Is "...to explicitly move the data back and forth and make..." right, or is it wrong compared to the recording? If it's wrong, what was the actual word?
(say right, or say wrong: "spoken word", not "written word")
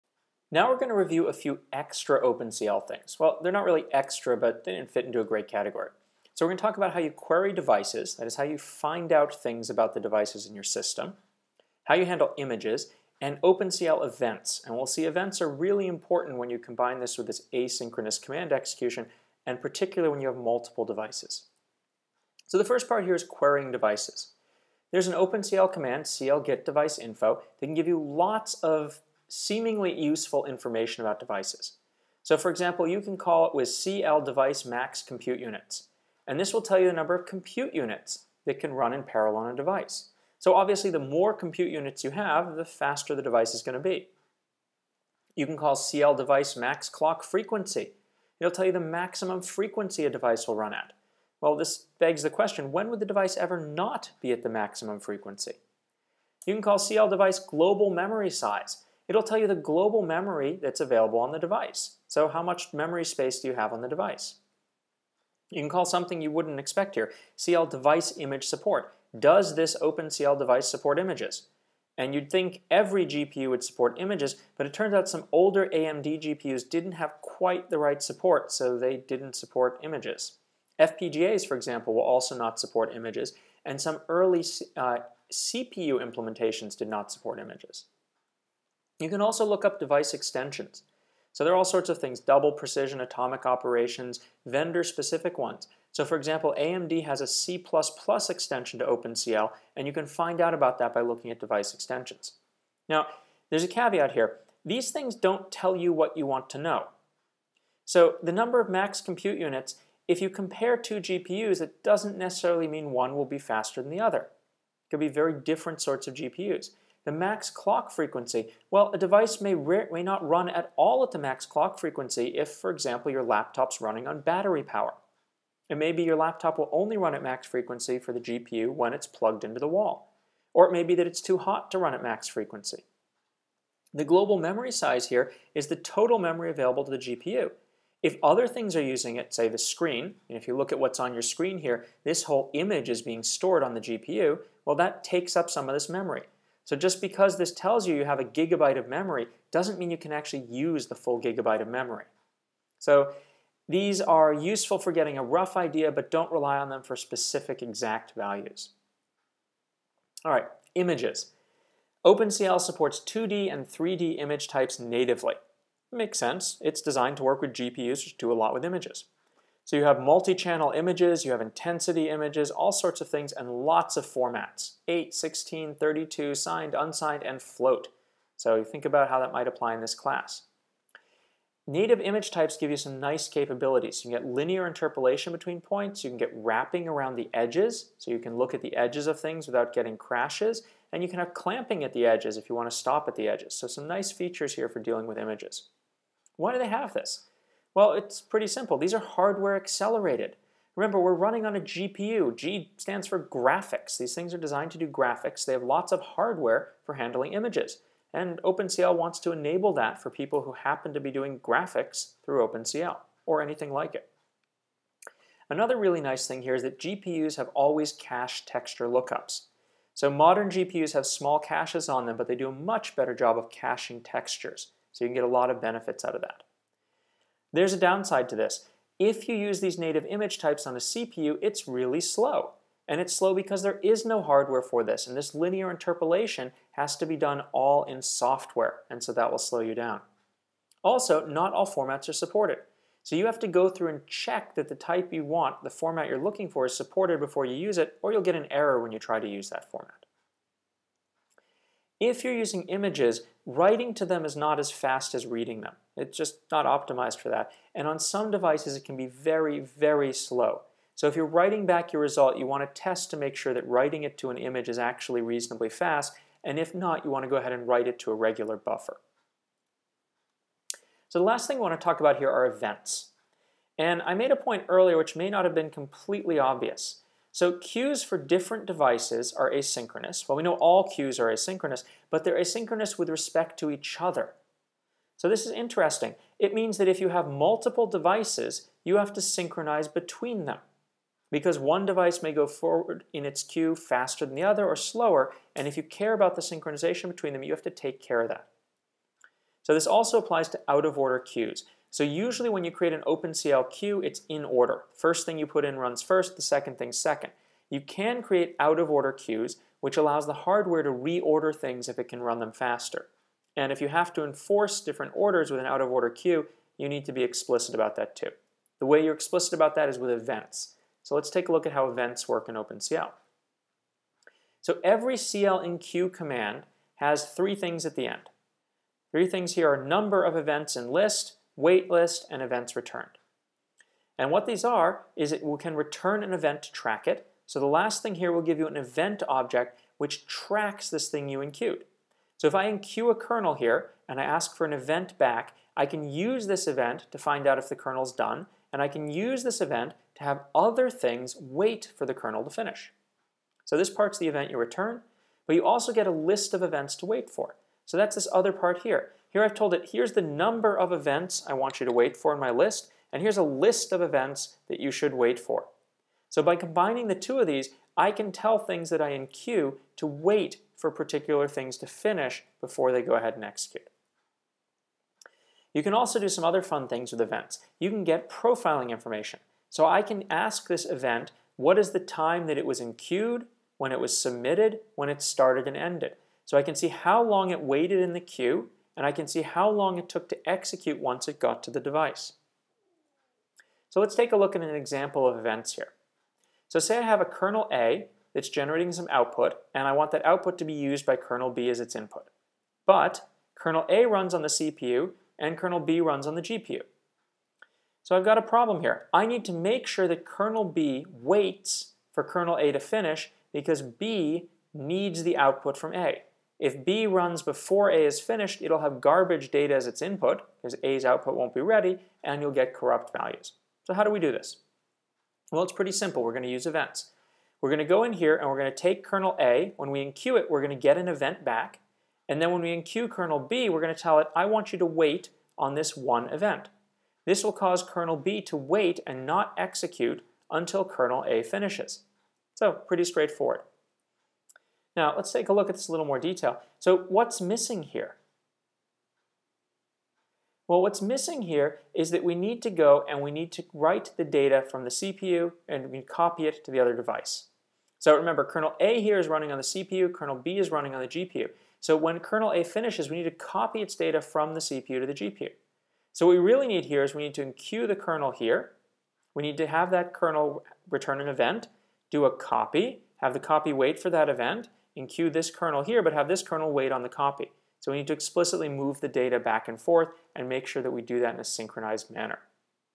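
right.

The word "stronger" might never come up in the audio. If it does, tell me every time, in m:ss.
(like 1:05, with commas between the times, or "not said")
not said.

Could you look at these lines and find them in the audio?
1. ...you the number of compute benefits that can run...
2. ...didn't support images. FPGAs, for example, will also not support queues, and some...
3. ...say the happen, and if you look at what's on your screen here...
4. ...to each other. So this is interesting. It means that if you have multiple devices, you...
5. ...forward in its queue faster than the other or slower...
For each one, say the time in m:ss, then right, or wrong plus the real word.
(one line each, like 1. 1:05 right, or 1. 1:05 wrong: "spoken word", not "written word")
1. 0:36 wrong: "units", not "benefits"
2. 1:18 wrong: "images", not "queues"
3. 2:19 wrong: "screen", not "happen"
4. 4:43 right
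5. 4:52 right.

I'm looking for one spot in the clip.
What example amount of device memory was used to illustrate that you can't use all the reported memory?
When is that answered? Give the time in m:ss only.
2:28.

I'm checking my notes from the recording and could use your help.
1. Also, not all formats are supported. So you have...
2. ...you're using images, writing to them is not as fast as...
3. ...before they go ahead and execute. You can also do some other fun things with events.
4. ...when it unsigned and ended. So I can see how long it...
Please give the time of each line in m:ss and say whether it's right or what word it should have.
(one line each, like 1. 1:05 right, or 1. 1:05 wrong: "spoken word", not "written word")
1. 4:00 right
2. 4:12 right
3. 6:12 right
4. 6:24 wrong: "started", not "unsigned".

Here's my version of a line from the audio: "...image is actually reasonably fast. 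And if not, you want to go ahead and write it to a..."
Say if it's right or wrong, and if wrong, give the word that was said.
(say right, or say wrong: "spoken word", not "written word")
right.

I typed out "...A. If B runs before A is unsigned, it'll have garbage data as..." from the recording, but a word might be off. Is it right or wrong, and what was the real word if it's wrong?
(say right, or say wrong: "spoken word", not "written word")
wrong: "finished", not "unsigned".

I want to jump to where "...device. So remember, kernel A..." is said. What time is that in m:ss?
7:36.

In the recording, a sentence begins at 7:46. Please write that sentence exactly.
So what we really need here is we need to enqueue the kernel here.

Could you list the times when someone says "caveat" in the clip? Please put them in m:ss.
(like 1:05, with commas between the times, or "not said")
1:43.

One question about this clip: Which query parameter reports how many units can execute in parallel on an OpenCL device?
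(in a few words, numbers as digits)
CL device max compute units.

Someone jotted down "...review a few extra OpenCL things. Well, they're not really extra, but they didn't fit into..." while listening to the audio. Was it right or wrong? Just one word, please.
right.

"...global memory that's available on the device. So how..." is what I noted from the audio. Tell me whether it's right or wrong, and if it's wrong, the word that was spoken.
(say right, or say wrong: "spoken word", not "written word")
right.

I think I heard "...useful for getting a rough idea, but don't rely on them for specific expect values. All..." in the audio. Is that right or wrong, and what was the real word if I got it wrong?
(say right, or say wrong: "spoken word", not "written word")
wrong: "exact", not "expect".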